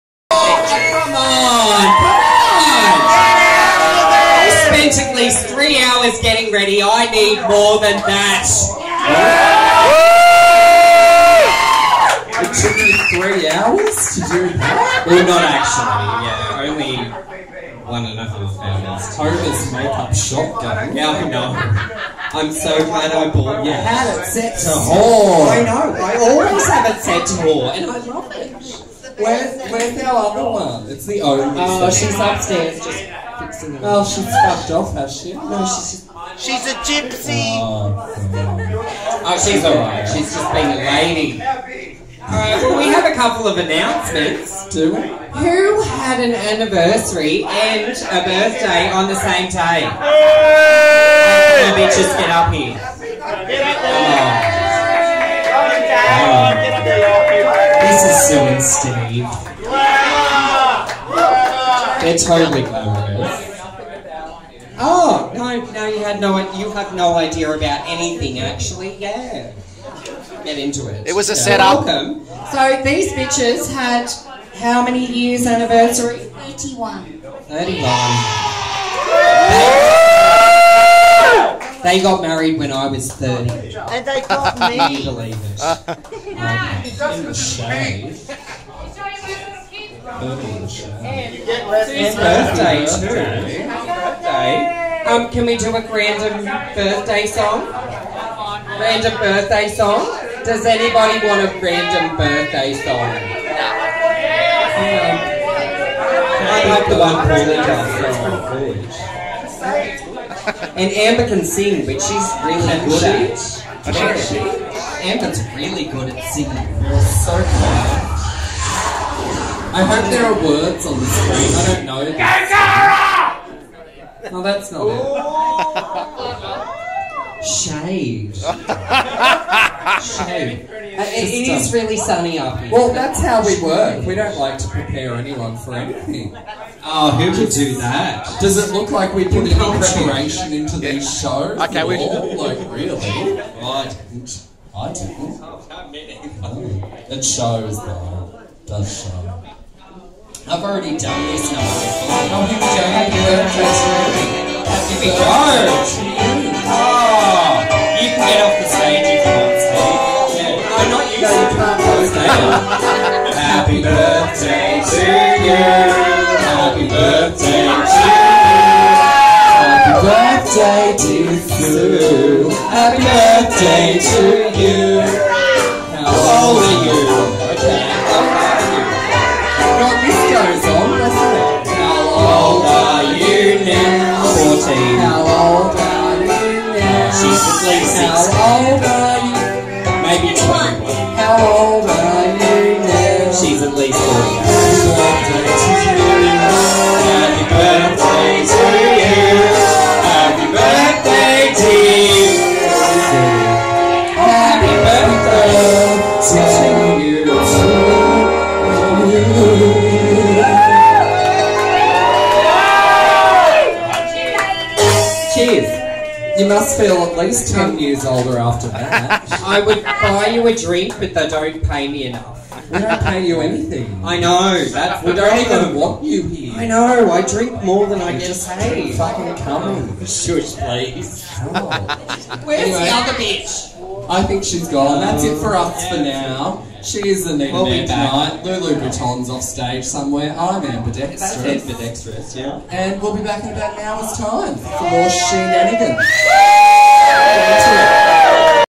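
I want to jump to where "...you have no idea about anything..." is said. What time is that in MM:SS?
01:06.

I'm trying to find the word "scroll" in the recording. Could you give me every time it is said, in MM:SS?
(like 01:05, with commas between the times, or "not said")
not said.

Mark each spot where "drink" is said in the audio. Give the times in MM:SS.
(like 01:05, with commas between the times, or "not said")
03:40, 03:47.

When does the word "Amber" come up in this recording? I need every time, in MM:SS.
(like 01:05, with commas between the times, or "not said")
01:50, 01:55.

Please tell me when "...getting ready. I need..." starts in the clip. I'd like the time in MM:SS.
00:06.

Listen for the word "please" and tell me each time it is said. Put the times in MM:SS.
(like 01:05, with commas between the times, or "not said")
03:50.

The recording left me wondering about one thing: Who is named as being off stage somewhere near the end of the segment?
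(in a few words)
Lulu Breton.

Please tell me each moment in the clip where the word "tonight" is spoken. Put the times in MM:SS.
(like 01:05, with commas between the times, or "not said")
03:57.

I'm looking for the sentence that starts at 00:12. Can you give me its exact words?
It took me three hours to do that?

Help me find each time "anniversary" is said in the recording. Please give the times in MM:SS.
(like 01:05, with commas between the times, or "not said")
00:46, 01:15.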